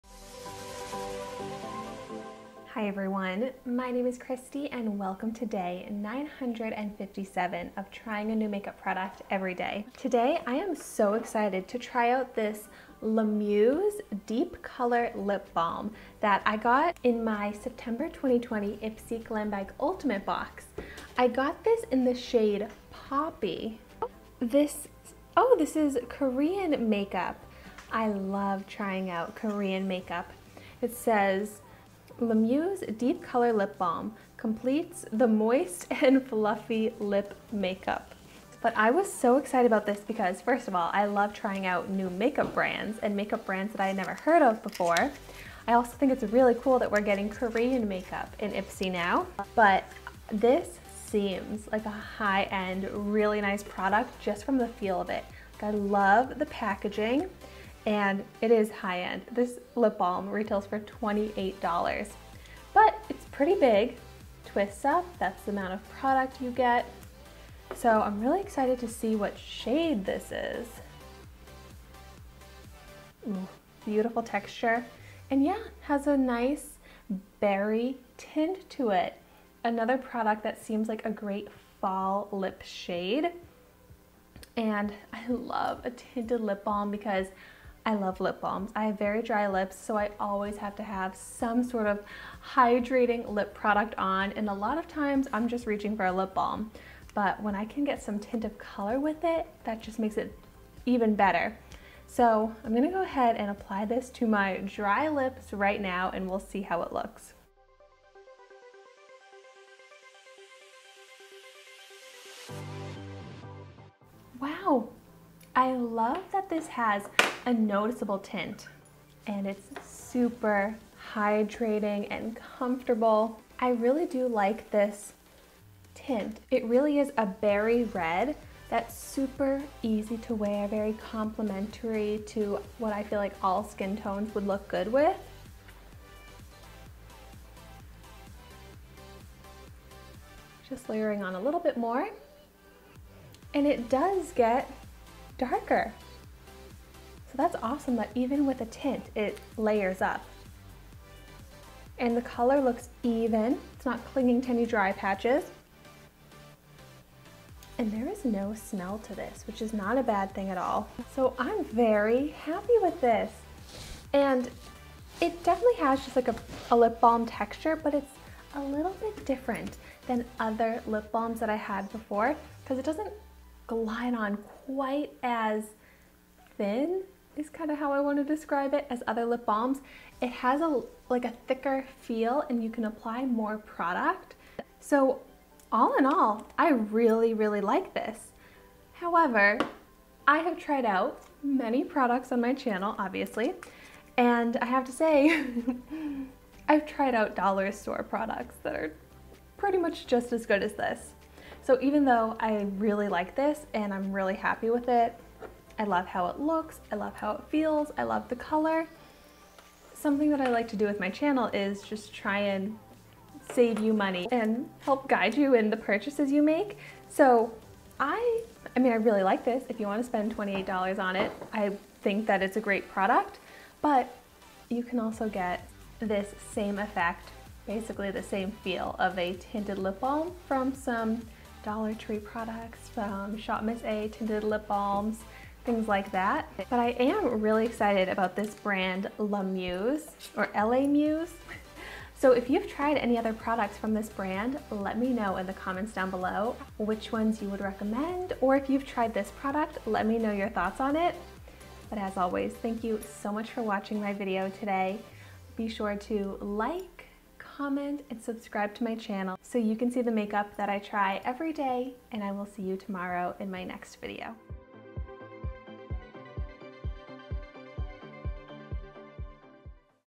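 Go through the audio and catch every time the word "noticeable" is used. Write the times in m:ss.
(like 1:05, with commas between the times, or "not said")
1:57.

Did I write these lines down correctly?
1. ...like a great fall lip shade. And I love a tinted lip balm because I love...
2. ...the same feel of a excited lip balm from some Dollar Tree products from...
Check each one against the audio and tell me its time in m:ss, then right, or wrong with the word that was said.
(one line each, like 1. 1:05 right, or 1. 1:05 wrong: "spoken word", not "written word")
1. 1:20 right
2. 3:48 wrong: "tinted", not "excited".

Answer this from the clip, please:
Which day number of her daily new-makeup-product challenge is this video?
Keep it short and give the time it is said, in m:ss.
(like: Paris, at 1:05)
957, at 0:05.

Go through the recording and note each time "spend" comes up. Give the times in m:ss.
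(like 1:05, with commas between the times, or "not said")
3:40.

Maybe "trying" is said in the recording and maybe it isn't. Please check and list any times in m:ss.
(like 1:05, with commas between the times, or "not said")
0:07, 0:28, 0:41.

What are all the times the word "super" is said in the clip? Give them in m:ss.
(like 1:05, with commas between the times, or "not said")
1:59, 2:08.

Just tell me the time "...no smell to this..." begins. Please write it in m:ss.
2:38.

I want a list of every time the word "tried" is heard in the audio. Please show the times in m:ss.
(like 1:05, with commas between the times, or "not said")
3:10, 3:16, 4:02, 4:08.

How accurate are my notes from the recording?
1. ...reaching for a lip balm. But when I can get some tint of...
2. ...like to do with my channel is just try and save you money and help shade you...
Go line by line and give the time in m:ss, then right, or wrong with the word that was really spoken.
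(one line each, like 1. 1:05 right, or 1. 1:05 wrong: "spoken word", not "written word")
1. 1:35 right
2. 3:30 wrong: "guide", not "shade".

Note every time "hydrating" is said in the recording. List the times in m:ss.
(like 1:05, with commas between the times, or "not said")
1:32, 2:01.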